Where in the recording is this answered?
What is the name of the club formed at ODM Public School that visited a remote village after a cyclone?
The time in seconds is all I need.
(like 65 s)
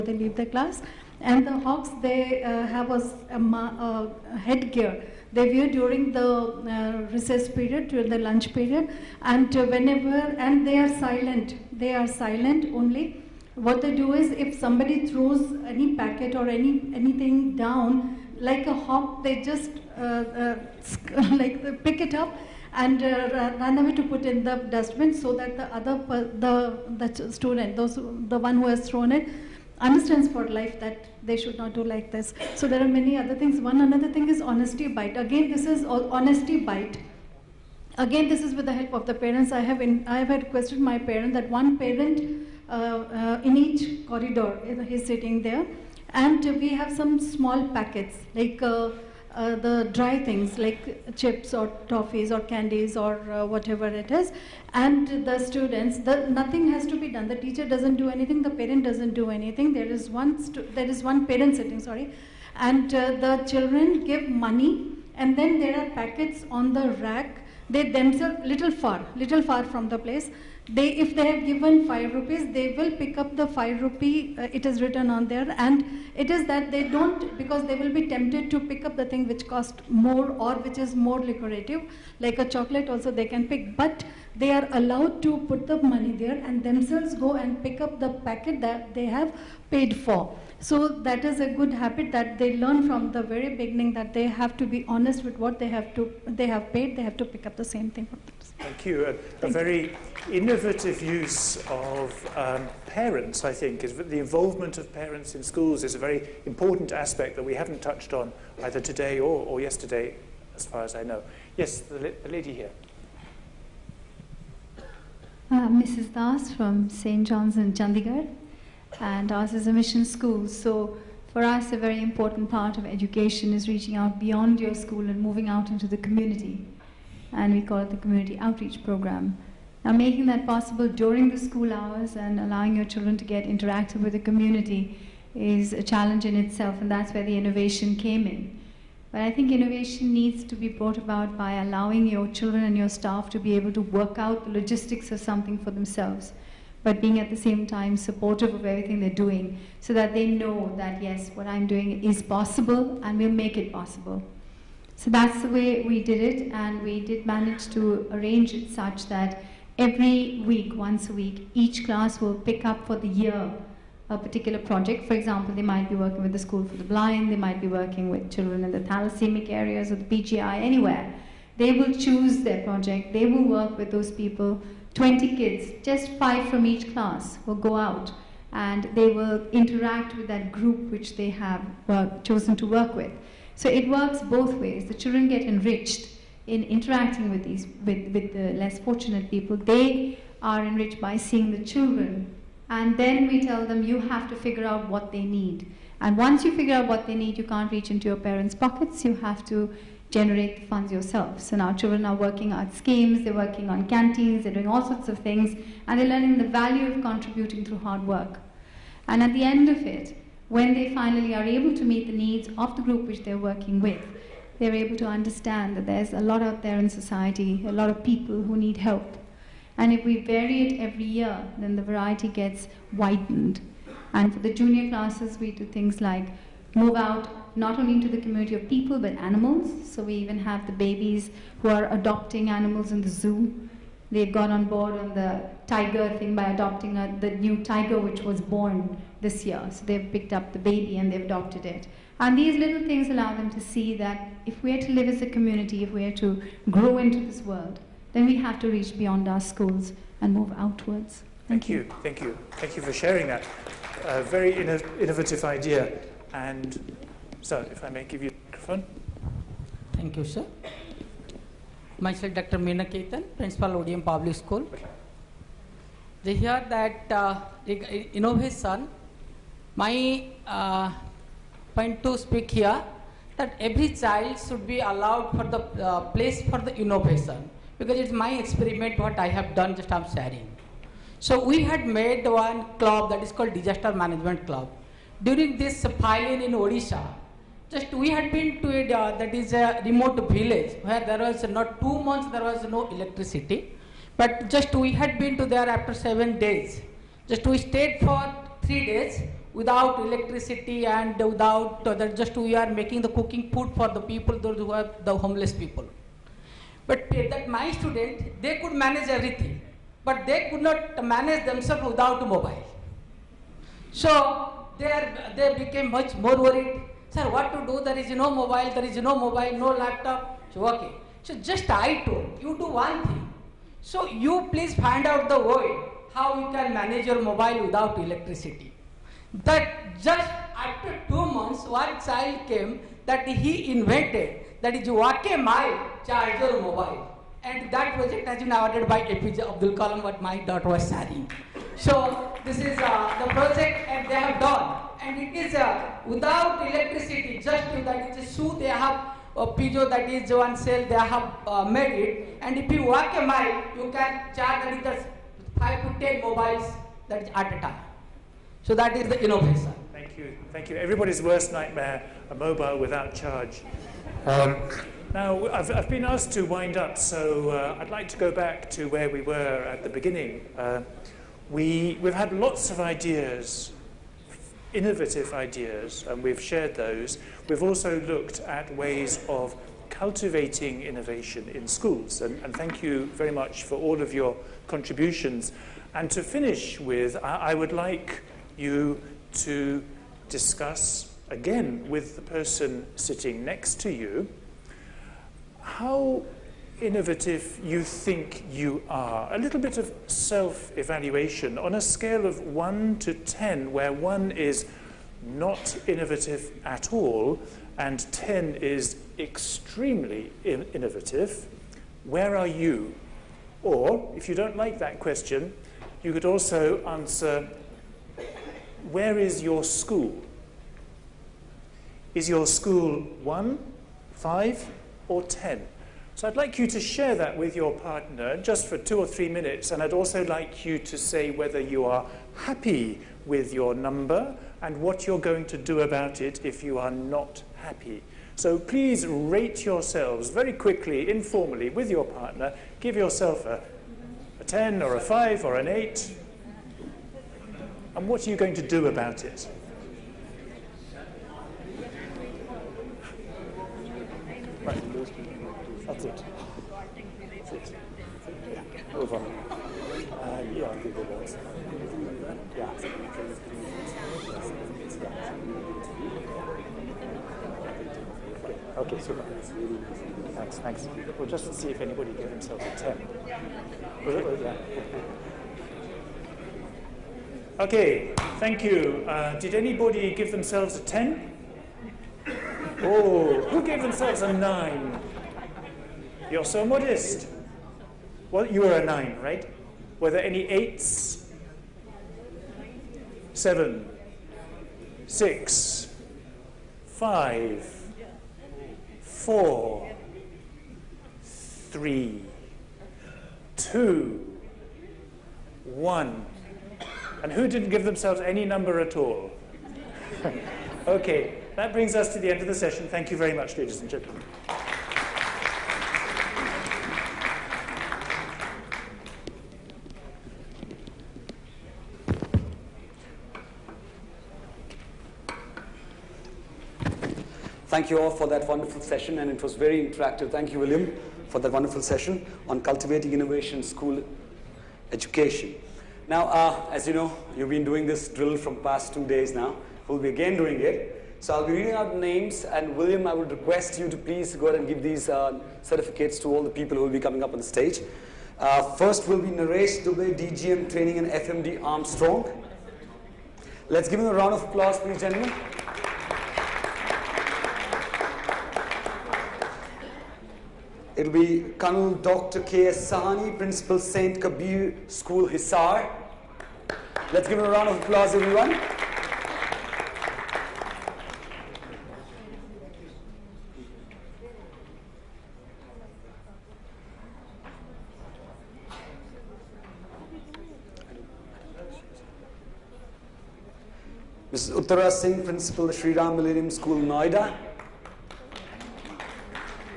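283 s.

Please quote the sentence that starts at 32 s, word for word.
So there are many other things.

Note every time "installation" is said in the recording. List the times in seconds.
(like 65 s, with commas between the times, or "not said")
not said.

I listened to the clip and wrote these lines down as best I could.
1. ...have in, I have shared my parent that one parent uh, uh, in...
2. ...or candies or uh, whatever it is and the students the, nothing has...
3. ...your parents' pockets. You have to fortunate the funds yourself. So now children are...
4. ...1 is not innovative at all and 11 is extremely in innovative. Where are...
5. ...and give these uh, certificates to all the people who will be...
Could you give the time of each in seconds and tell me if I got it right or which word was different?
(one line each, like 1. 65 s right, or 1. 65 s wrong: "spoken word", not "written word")
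1. 39 s wrong: "requested", not "shared"
2. 52 s right
3. 198 s wrong: "generate", not "fortunate"
4. 403 s wrong: "10", not "11"
5. 544 s right.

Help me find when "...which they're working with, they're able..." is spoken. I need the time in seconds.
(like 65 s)
213 s.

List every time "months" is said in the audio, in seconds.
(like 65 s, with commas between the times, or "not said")
292 s, 331 s.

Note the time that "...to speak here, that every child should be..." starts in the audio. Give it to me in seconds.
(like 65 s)
272 s.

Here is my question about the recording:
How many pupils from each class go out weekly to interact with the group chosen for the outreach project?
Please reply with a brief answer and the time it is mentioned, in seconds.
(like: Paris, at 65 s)
5, at 175 s.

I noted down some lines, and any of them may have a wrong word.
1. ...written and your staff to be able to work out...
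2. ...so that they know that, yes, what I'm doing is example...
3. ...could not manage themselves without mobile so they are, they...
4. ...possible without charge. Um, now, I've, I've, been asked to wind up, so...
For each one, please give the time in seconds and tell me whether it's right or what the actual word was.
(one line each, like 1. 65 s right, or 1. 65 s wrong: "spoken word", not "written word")
1. 142 s wrong: "children", not "written"
2. 149 s wrong: "possible", not "example"
3. 310 s right
4. 362 s wrong: "mobile", not "possible".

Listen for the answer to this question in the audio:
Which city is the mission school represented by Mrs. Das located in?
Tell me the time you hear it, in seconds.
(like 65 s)
117 s.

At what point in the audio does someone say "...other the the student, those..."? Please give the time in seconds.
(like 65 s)
25 s.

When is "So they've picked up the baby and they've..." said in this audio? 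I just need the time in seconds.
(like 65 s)
239 s.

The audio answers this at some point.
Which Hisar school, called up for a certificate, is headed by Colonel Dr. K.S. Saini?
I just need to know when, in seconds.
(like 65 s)
563 s.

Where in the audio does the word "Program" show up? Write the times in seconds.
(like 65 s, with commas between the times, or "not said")
128 s.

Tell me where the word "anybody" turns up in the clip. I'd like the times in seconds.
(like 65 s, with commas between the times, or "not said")
471 s, 479 s.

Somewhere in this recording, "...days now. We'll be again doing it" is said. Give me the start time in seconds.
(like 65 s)
539 s.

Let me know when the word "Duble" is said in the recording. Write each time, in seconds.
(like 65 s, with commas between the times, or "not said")
549 s.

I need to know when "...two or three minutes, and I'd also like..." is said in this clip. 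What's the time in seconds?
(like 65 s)
428 s.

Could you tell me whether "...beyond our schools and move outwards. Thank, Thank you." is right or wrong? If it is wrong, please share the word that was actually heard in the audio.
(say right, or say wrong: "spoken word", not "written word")
right.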